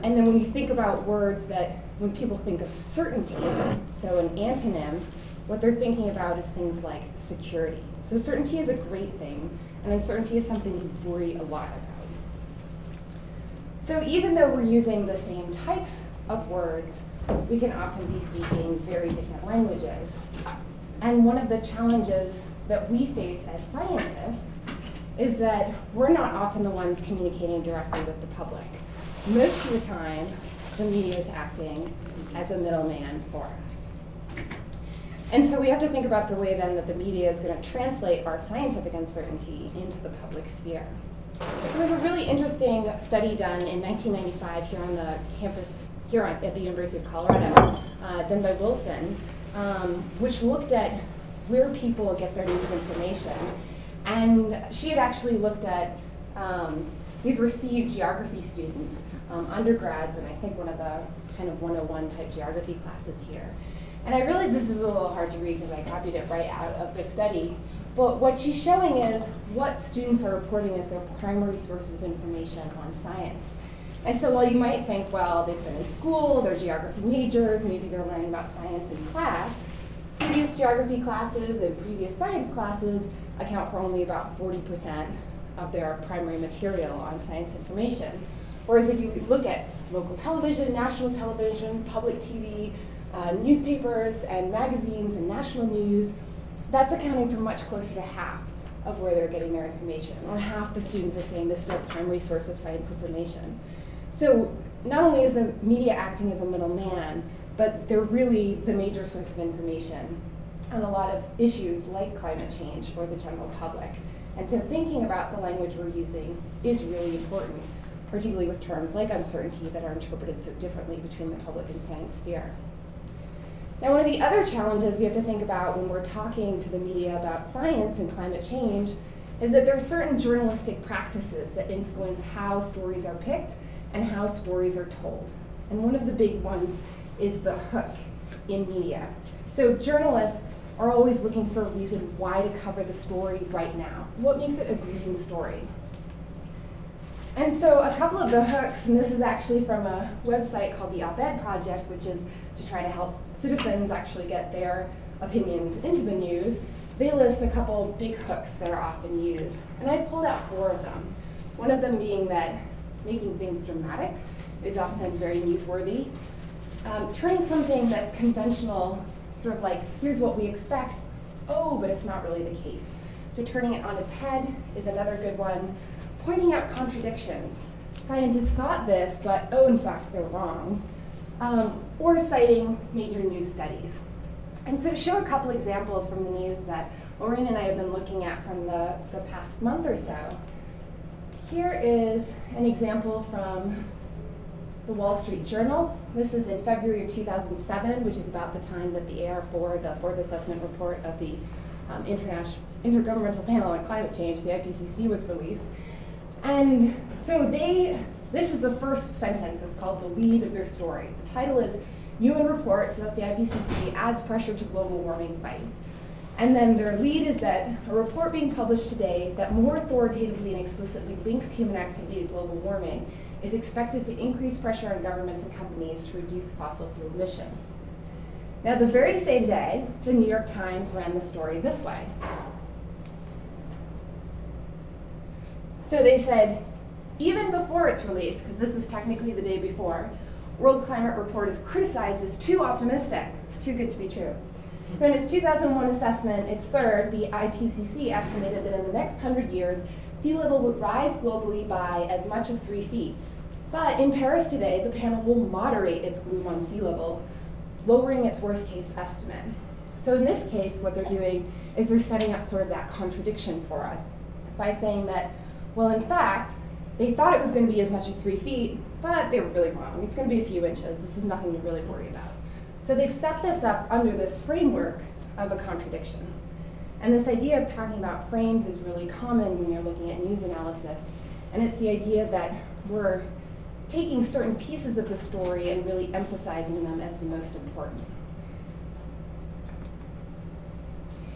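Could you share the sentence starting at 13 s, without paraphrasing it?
So even though we're using the same types of words, we can often be speaking very different languages.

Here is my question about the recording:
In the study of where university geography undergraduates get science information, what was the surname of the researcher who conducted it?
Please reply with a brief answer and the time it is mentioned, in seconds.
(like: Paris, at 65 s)
Wilson, at 48 s.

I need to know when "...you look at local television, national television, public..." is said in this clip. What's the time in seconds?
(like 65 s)
88 s.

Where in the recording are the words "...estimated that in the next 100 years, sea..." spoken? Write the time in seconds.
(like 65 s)
248 s.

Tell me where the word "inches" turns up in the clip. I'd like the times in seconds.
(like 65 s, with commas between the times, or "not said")
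270 s.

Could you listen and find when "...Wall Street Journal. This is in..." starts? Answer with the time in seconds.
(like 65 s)
194 s.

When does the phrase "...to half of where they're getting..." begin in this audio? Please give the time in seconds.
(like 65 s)
97 s.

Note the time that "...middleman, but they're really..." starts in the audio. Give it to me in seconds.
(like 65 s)
106 s.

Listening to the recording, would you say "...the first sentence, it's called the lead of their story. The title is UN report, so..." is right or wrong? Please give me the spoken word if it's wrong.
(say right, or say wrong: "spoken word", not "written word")
right.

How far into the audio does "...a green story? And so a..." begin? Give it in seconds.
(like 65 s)
144 s.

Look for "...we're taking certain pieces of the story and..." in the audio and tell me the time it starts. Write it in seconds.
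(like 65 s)
282 s.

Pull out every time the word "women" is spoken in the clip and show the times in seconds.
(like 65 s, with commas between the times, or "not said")
not said.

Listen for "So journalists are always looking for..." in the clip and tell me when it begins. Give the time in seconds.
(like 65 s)
139 s.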